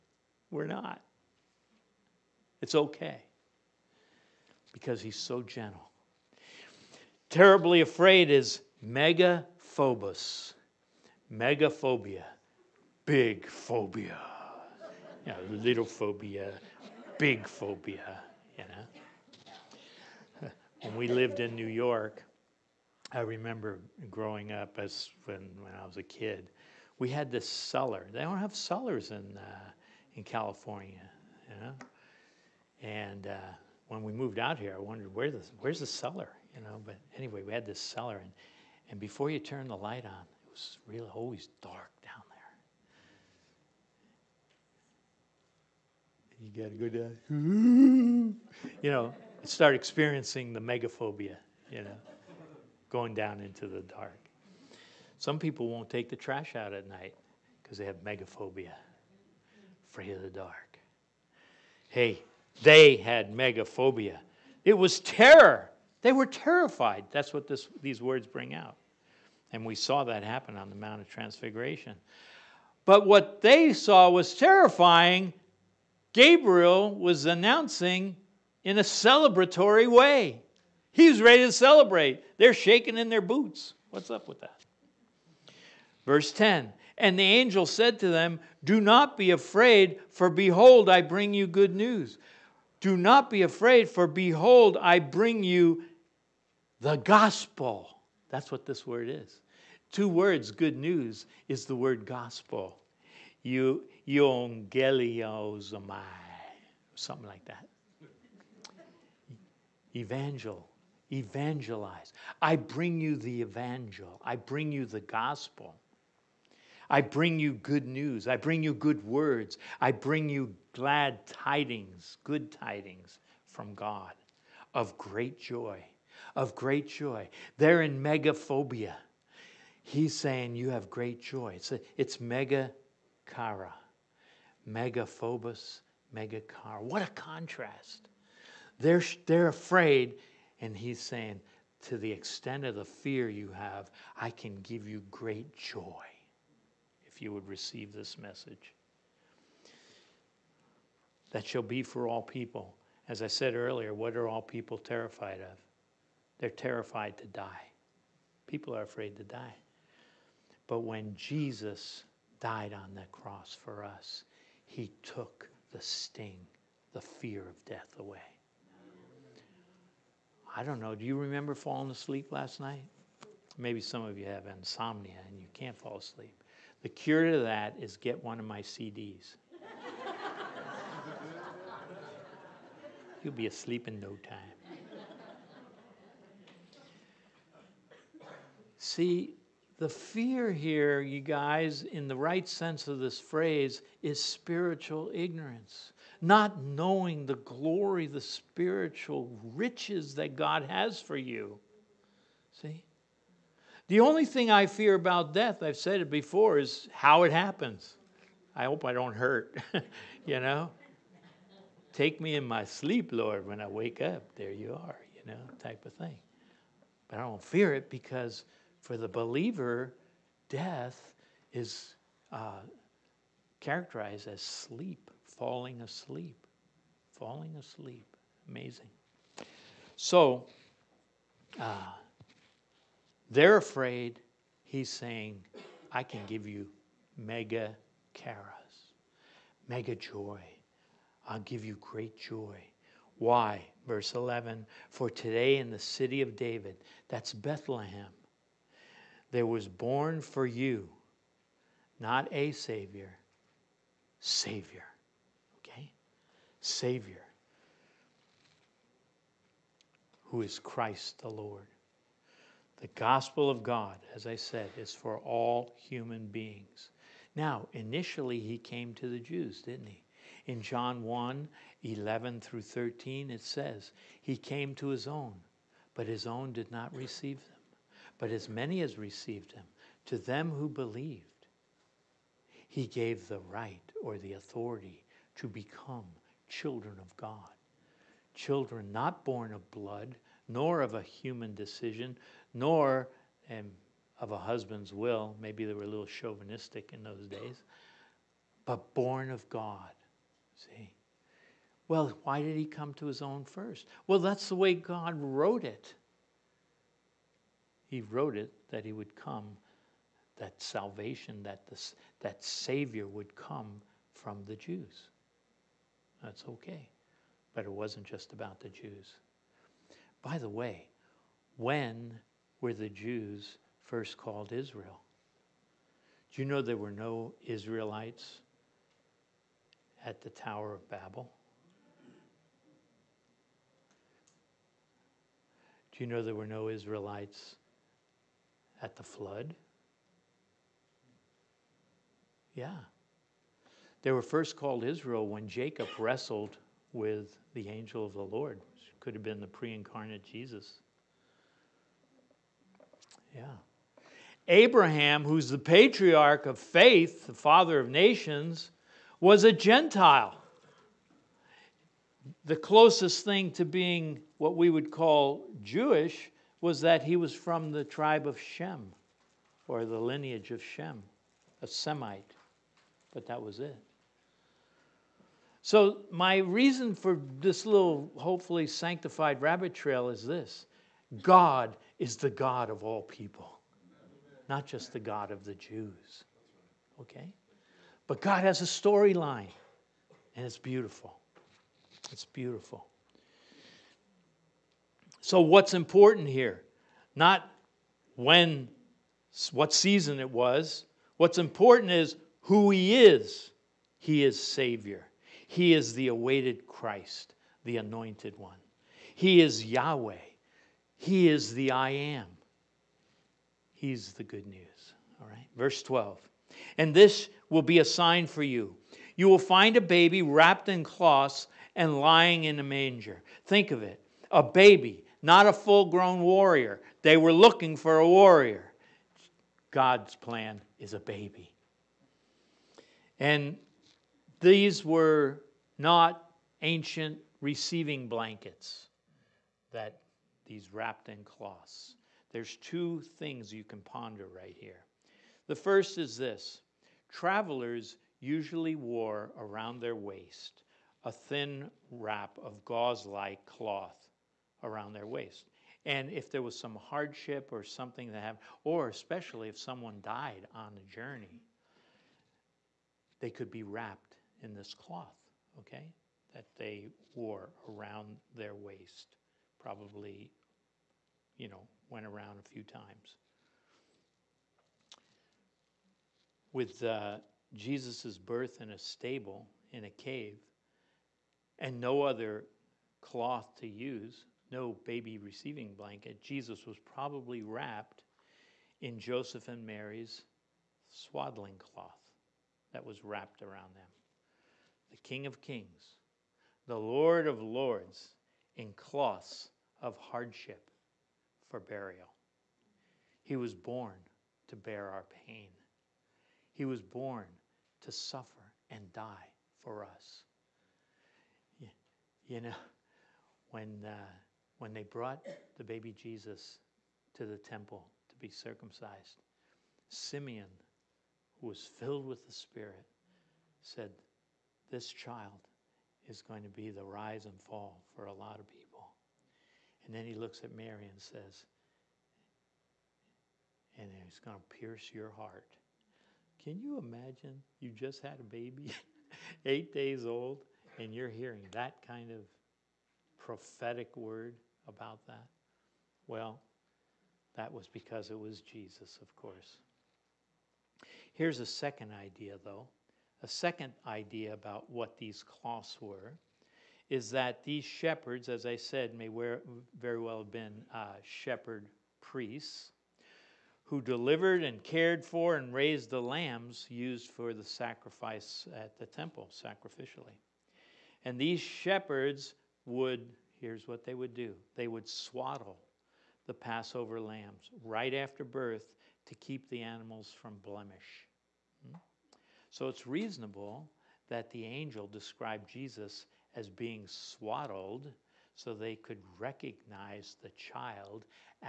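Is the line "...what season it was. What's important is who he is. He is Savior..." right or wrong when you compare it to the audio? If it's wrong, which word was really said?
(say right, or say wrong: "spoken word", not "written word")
right.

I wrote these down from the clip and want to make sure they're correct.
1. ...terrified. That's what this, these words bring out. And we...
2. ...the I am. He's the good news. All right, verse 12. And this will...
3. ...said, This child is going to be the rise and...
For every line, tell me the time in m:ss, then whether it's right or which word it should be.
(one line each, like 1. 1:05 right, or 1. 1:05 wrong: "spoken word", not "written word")
1. 1:06 right
2. 6:51 right
3. 8:43 right.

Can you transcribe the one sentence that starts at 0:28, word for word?
They don't have cellars in, uh, in California, you know.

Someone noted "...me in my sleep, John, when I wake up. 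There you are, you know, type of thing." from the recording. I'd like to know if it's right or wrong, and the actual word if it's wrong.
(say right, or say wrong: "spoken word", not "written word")
wrong: "Lord", not "John".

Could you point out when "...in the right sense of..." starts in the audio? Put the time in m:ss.
3:11.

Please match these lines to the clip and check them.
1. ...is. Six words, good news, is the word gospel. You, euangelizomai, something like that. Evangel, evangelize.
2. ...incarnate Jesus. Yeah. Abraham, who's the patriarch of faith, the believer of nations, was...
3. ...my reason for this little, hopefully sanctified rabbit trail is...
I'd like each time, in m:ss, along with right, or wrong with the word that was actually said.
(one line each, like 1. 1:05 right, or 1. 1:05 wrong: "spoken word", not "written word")
1. 1:39 wrong: "Two", not "Six"
2. 5:49 wrong: "father", not "believer"
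3. 6:16 right.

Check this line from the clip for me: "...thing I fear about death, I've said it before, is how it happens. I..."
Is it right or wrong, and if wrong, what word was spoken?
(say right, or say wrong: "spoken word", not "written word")
right.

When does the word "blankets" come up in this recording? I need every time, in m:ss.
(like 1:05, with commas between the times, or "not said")
7:18, 8:05.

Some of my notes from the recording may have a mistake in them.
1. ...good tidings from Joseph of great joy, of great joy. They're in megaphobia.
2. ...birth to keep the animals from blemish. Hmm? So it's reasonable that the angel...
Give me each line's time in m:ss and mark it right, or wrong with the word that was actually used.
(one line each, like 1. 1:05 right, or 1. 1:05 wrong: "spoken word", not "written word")
1. 2:02 wrong: "God", not "Joseph"
2. 9:38 right.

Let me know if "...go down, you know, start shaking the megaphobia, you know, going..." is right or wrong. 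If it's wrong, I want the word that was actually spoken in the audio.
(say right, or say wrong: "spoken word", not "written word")
wrong: "experiencing", not "shaking".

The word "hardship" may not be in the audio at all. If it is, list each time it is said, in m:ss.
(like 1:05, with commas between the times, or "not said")
7:36, 8:19.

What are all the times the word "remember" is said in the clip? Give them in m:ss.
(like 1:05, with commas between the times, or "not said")
0:23, 2:51.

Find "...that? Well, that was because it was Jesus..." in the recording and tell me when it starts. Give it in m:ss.
9:05.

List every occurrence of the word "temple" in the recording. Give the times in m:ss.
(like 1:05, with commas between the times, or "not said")
8:37, 9:28.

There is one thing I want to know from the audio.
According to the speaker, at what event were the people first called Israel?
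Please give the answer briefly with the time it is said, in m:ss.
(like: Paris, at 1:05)
Jacob wrestled with the angel, at 5:45.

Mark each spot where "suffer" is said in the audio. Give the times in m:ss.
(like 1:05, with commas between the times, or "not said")
8:27.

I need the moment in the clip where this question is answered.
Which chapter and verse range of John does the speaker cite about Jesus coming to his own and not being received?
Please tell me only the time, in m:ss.
4:30.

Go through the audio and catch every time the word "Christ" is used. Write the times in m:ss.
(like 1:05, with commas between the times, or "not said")
4:20, 6:46.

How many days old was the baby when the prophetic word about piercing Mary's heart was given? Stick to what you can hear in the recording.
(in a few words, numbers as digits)
8.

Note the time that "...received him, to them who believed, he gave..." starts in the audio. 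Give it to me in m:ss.
4:38.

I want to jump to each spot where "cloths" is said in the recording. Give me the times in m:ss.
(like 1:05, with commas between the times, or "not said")
7:00, 7:21, 7:33, 7:44, 8:03, 8:11, 8:18, 9:15.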